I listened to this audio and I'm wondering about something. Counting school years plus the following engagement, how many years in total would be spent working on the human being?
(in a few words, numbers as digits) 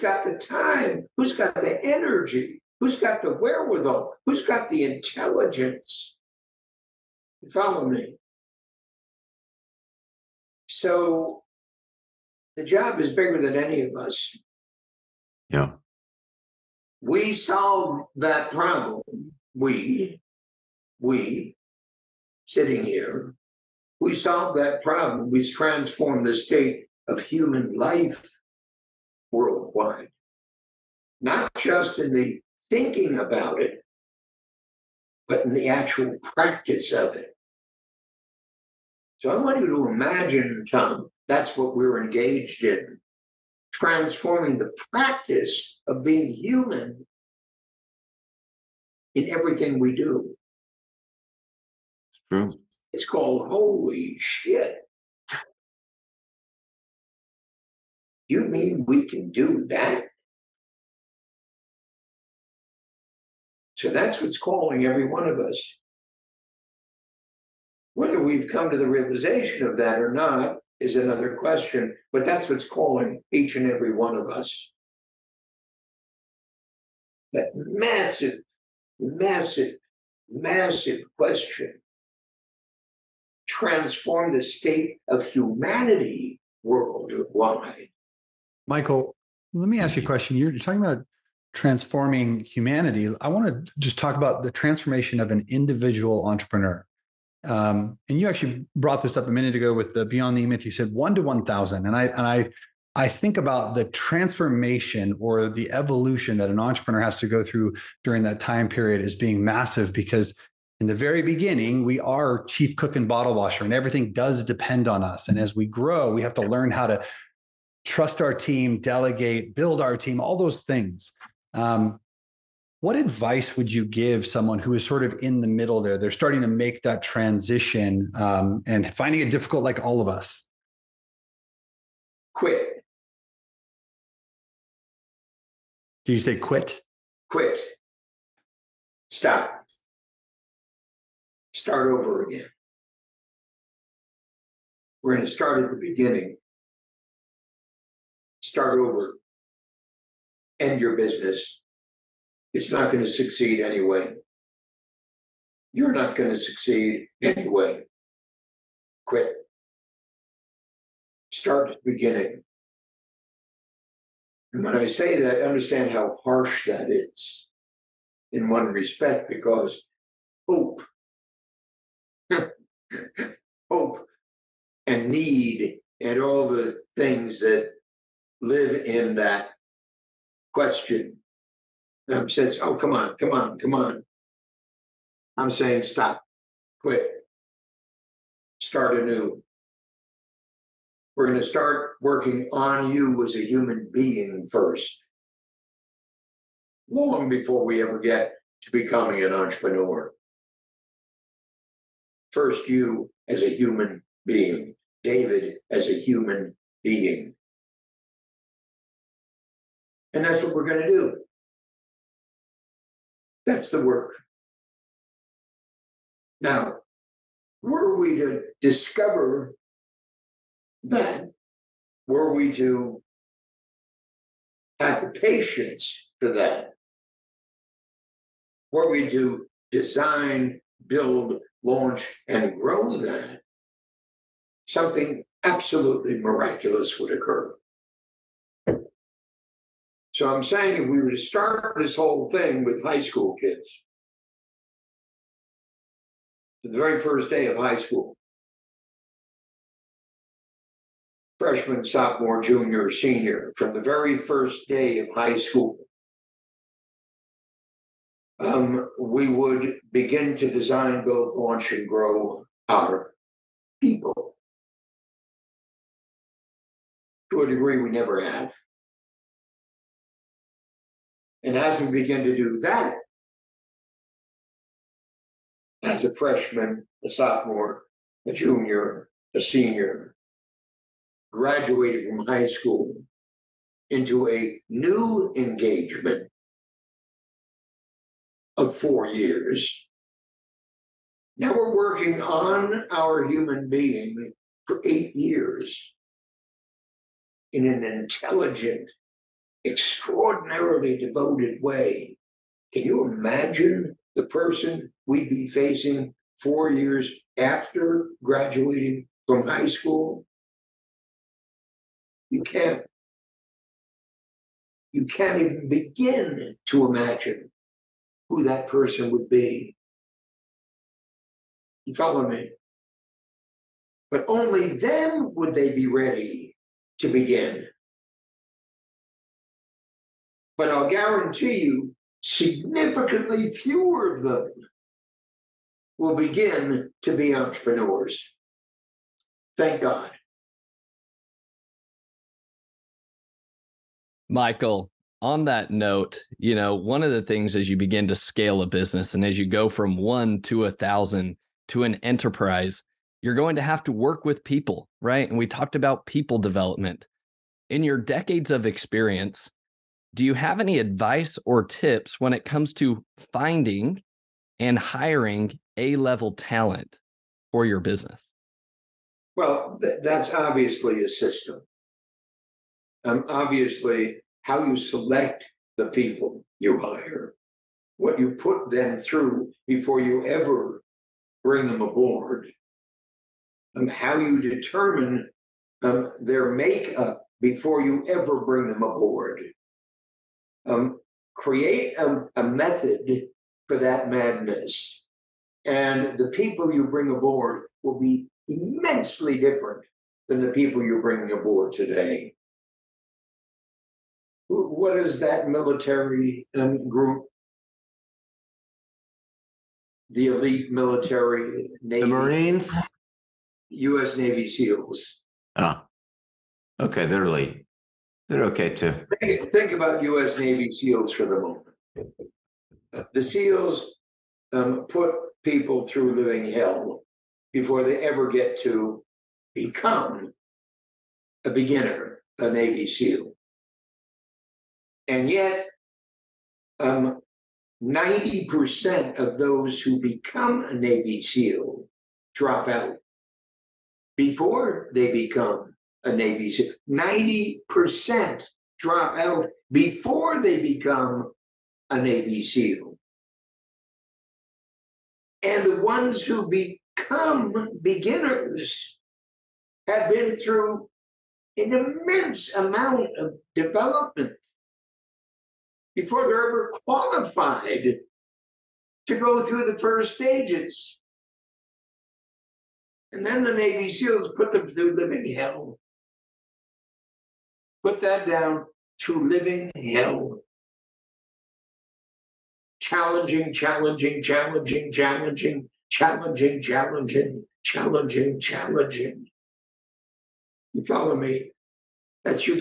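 8.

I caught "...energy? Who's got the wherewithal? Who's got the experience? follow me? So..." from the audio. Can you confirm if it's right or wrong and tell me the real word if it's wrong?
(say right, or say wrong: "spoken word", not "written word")
wrong: "intelligence", not "experience".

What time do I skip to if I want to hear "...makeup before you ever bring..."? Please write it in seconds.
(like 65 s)
386 s.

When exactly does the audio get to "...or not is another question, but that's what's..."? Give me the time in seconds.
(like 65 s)
69 s.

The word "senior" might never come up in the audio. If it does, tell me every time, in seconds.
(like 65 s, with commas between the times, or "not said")
252 s, 279 s.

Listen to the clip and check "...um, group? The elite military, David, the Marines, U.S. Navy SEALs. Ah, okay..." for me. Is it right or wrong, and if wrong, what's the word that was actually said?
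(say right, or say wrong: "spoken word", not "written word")
wrong: "Navy", not "David".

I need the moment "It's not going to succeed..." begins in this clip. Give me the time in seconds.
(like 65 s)
152 s.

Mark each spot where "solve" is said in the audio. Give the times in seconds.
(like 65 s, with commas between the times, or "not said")
17 s, 24 s.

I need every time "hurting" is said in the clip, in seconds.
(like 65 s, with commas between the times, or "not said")
not said.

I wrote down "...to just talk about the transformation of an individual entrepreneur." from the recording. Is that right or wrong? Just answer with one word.
right.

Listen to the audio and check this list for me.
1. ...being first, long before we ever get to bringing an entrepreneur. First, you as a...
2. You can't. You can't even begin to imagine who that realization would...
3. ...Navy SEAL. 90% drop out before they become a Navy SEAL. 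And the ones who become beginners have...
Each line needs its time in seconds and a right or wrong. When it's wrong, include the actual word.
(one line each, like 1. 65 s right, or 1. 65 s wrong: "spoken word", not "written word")
1. 193 s wrong: "becoming", not "bringing"
2. 312 s wrong: "person", not "realization"
3. 446 s right.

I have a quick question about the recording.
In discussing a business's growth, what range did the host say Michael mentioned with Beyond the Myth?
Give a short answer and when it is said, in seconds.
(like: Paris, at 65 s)
one to one thousand, at 100 s.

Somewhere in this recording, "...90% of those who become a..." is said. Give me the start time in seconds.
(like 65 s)
437 s.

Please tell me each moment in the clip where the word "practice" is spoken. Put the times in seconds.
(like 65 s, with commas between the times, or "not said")
36 s, 44 s.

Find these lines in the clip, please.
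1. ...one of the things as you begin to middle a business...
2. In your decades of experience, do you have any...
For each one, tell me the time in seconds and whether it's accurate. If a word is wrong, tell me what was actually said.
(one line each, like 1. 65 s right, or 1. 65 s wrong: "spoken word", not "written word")
1. 346 s wrong: "scale", not "middle"
2. 357 s right.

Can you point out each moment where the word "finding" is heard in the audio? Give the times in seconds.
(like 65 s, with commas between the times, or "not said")
128 s, 363 s.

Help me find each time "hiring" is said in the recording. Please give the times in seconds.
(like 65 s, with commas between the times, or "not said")
364 s.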